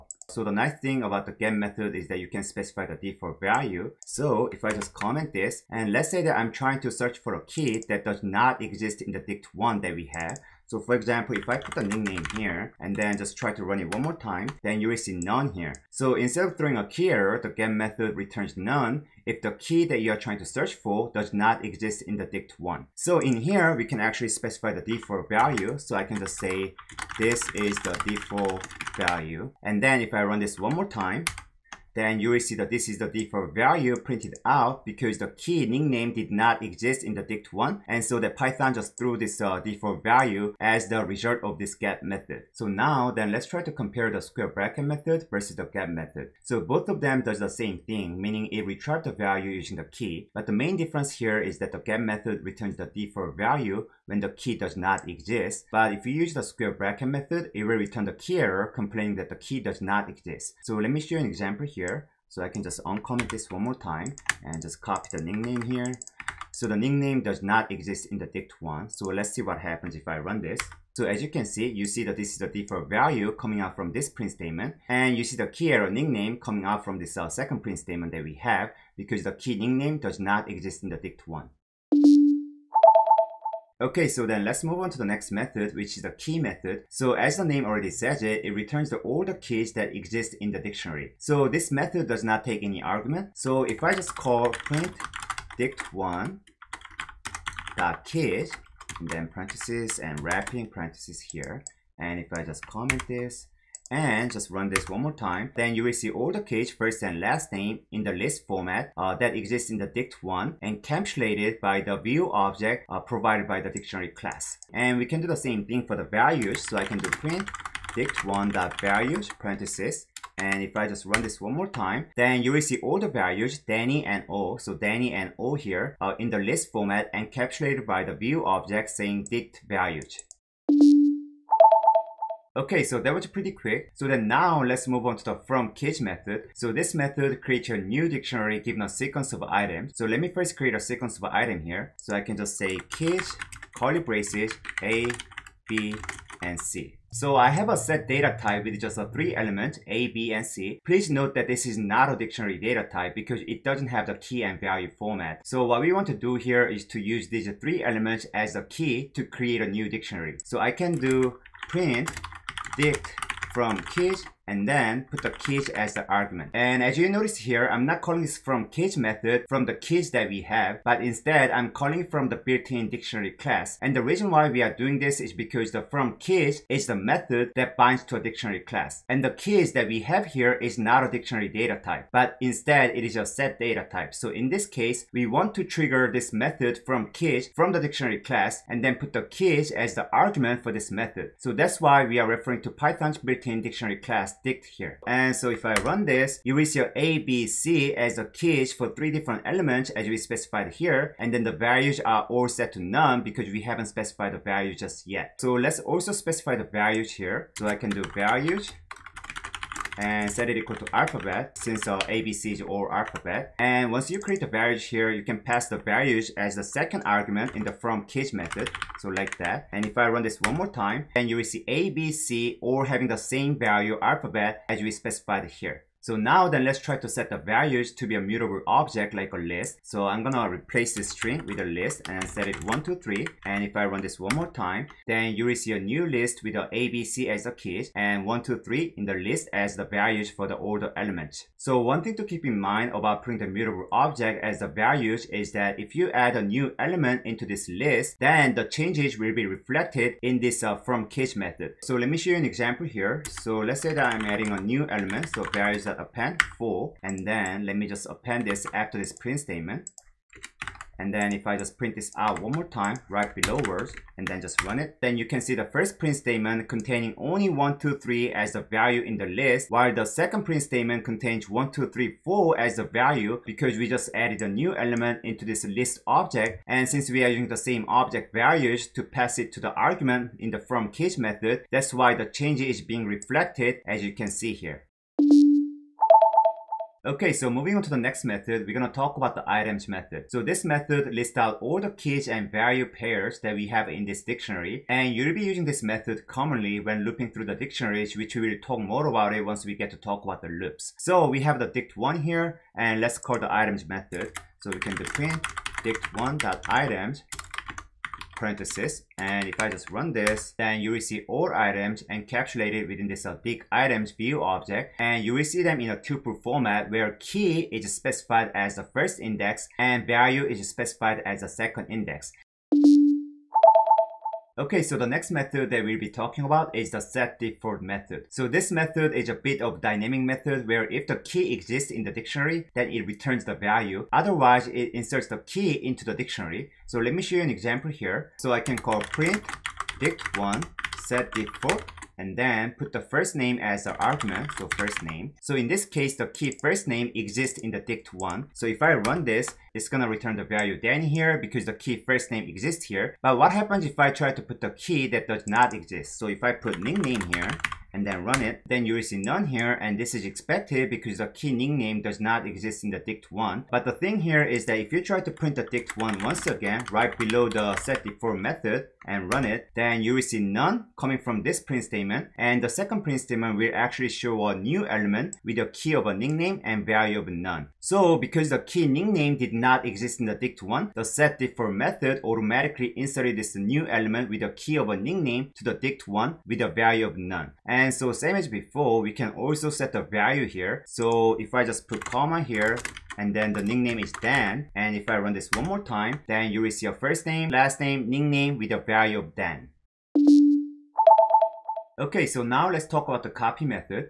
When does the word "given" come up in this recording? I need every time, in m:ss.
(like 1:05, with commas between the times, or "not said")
2:18.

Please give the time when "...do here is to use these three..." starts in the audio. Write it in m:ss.
2:36.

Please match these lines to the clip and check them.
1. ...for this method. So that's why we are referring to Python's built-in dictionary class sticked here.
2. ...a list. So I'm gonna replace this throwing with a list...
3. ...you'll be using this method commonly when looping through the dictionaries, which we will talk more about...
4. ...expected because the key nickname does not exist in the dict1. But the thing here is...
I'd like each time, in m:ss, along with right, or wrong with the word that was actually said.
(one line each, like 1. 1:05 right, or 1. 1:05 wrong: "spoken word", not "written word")
1. 3:10 right
2. 3:49 wrong: "string", not "throwing"
3. 4:55 right
4. 6:00 right.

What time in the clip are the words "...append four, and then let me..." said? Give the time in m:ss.
4:15.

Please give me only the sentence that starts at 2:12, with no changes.
Okay, so that was pretty quick.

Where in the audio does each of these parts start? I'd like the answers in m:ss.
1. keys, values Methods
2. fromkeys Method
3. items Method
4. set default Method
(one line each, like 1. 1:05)
1. 1:23
2. 2:12
3. 4:46
4. 5:24.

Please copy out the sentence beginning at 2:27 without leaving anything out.
So I have a set data type with just a three element A, B, and C.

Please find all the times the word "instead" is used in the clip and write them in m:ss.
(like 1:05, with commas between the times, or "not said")
0:16, 2:51, 3:02.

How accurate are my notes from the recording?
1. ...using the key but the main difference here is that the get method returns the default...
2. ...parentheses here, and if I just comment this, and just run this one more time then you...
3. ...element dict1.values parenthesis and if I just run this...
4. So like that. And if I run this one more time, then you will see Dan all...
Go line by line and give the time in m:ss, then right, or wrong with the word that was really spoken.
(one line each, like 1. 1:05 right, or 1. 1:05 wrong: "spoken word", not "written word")
1. 0:49 right
2. 1:40 right
3. 1:57 wrong: "print", not "element"
4. 3:38 wrong: "ABC", not "Dan".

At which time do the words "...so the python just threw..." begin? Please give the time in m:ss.
0:38.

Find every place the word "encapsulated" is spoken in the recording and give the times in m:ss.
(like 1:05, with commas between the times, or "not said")
1:50, 2:07, 5:12.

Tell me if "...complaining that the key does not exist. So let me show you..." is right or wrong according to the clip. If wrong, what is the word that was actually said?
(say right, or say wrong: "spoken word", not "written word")
right.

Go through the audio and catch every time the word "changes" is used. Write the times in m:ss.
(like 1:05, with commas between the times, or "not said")
4:08, 4:42.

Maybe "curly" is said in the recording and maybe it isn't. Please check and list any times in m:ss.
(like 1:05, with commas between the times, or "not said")
2:23.